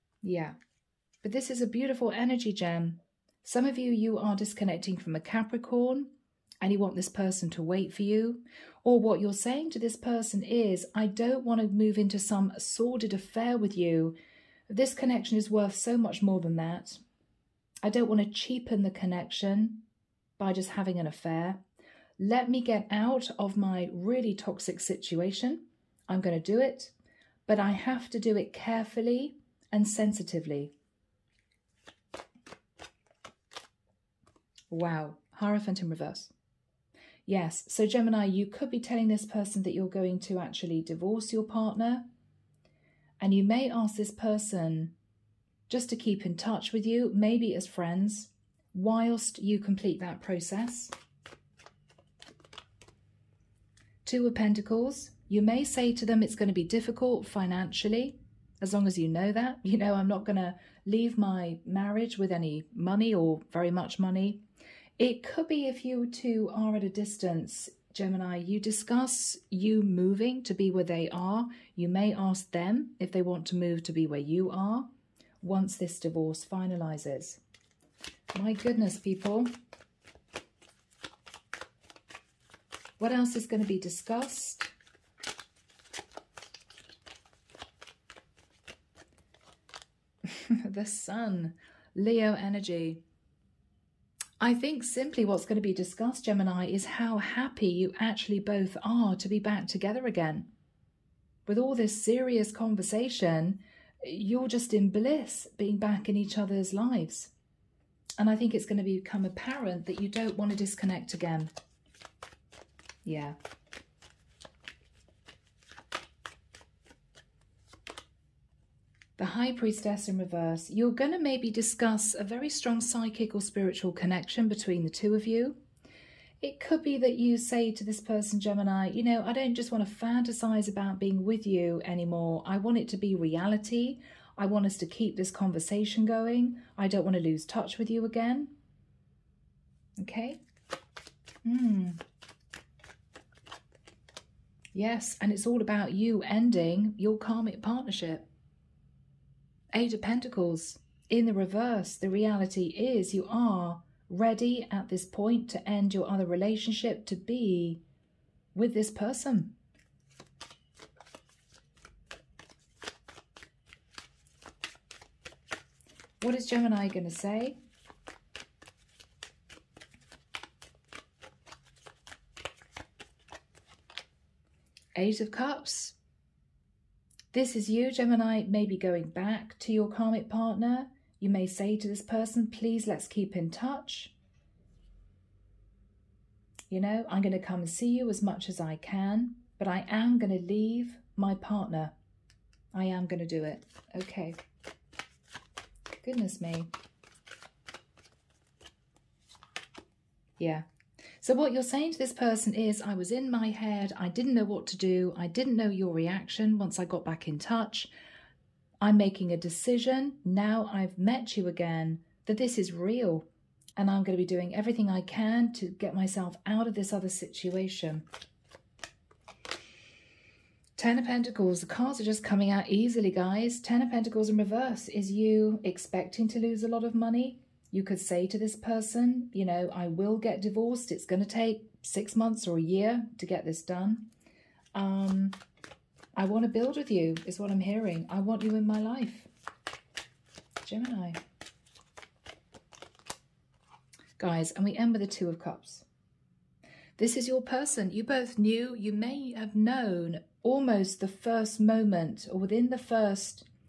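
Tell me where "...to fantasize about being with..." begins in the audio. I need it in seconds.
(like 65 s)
129 s.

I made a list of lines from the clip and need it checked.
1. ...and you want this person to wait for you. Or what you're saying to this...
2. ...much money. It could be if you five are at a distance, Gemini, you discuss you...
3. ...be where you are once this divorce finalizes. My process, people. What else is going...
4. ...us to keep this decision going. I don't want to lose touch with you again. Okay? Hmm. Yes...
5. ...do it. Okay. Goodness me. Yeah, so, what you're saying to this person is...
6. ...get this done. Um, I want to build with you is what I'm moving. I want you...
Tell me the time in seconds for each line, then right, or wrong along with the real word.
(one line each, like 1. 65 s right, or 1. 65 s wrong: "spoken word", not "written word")
1. 6 s right
2. 63 s wrong: "two", not "five"
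3. 73 s wrong: "goodness", not "process"
4. 134 s wrong: "conversation", not "decision"
5. 193 s right
6. 233 s wrong: "hearing", not "moving".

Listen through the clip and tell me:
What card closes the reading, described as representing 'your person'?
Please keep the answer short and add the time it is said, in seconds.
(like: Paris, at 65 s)
Two of Cups, at 245 s.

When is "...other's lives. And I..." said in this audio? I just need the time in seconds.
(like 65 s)
106 s.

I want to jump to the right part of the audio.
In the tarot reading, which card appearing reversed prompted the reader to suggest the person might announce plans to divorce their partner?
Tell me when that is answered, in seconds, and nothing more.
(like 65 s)
35 s.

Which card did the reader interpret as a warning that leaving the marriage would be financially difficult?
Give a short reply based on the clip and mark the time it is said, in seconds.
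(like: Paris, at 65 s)
Two of Pentacles, at 54 s.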